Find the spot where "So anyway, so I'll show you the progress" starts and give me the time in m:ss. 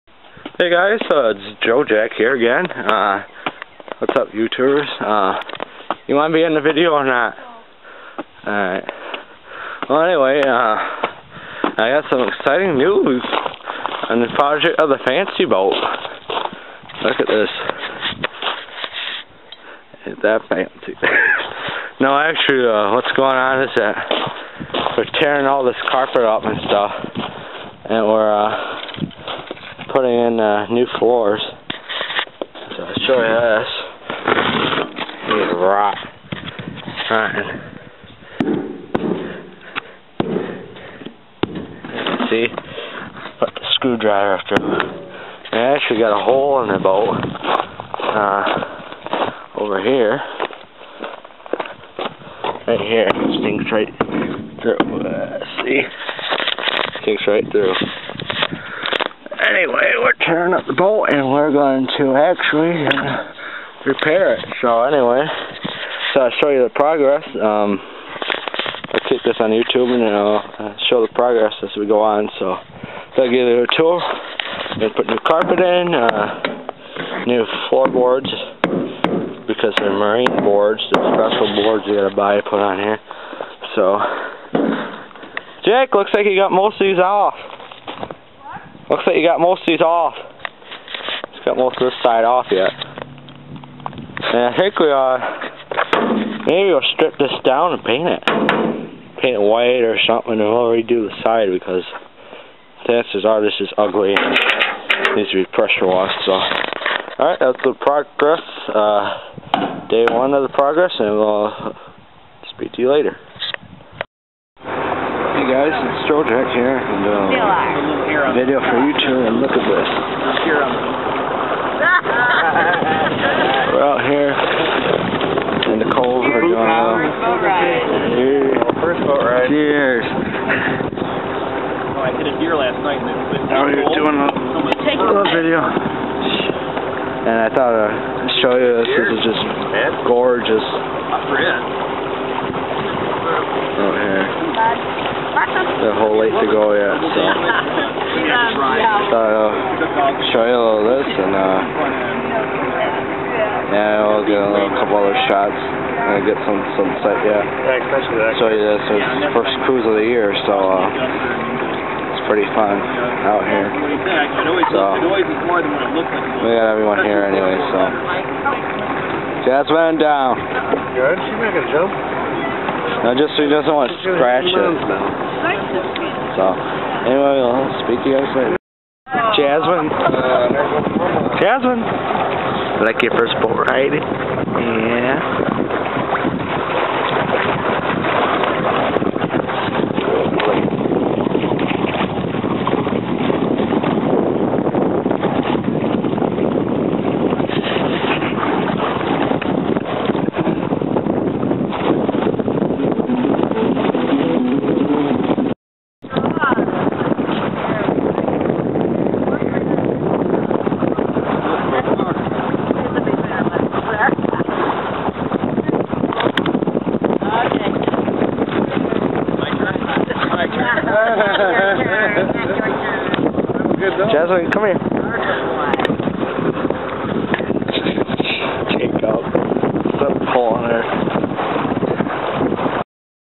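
1:04.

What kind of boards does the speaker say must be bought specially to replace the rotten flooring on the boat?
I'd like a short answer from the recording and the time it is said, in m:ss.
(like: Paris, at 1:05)
Marine boards, at 1:19.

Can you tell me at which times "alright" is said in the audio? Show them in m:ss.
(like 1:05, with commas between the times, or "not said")
0:08, 1:46, 2:51.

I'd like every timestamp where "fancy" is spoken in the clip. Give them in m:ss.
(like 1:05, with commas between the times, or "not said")
0:15, 0:20.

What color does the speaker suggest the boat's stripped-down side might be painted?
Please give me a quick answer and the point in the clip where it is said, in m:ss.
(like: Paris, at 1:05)
White, at 1:39.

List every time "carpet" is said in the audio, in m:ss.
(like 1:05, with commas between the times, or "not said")
0:25, 1:15.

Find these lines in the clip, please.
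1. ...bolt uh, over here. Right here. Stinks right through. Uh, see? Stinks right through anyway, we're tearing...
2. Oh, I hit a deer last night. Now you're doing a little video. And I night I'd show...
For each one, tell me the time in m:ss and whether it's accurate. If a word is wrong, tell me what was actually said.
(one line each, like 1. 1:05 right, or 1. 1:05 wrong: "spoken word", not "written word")
1. 0:46 right
2. 2:10 wrong: "thought", not "night".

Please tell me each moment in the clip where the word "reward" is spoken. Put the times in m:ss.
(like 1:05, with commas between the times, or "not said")
not said.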